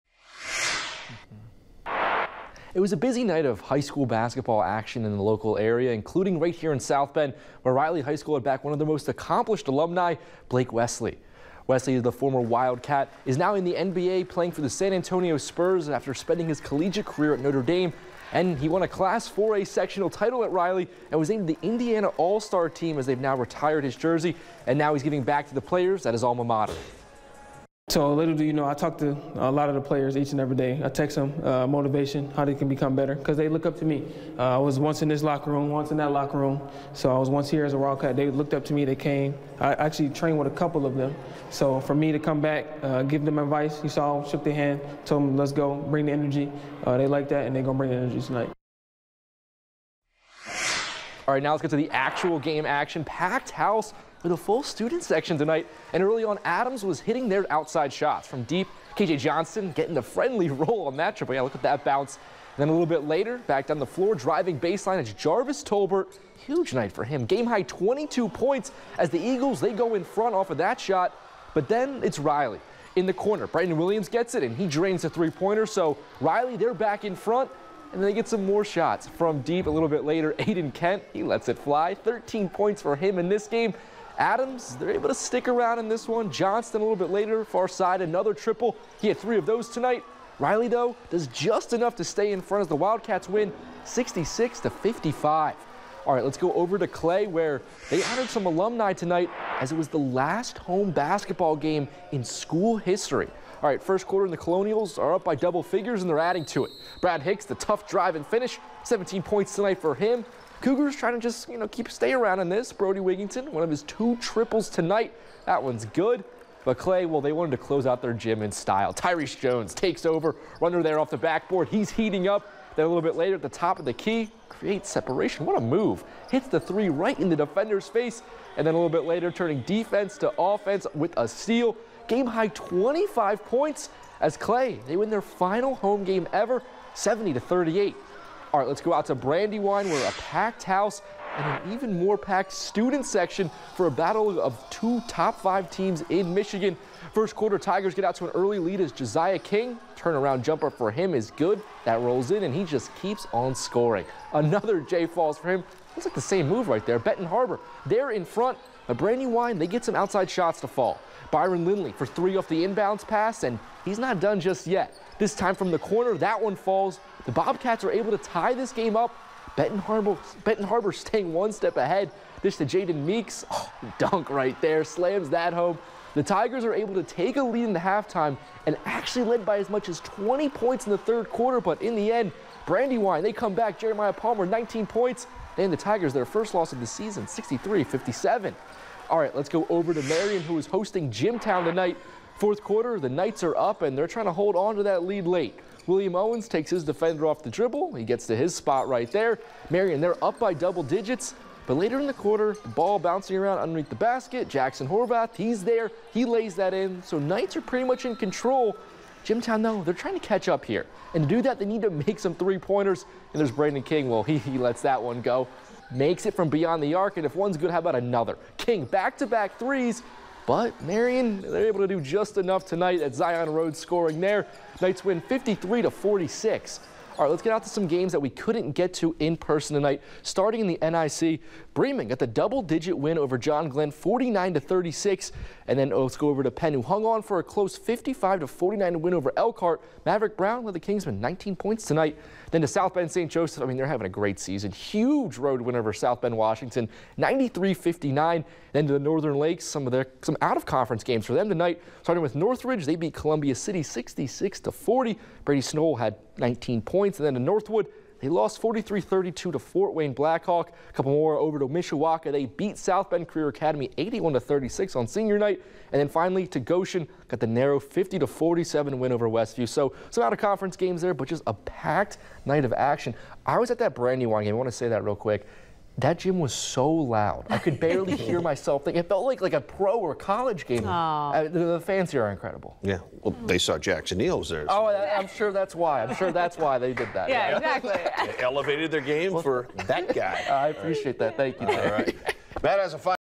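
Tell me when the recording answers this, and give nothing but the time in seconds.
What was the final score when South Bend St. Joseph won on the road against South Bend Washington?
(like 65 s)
247 s.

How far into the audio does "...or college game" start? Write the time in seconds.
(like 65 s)
279 s.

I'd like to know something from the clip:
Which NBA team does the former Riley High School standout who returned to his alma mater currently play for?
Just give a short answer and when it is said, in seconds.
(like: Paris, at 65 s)
San Antonio Spurs, at 14 s.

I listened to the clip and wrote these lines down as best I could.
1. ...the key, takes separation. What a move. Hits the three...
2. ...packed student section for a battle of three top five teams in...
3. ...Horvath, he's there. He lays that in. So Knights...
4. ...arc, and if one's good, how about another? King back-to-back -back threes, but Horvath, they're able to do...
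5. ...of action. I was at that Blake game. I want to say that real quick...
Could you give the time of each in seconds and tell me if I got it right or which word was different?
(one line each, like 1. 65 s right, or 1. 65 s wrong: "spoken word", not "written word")
1. 123 s wrong: "creates", not "takes"
2. 142 s wrong: "two", not "three"
3. 204 s right
4. 216 s wrong: "Marian", not "Horvath"
5. 272 s wrong: "Brandywine", not "Blake".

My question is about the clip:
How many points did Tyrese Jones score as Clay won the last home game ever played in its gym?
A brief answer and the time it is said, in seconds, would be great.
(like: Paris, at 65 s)
25, at 132 s.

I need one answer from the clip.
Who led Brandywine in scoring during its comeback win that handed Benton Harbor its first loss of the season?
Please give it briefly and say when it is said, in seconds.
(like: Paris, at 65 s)
Jeremiah Palmer, at 183 s.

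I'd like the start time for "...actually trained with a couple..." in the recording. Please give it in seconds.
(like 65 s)
39 s.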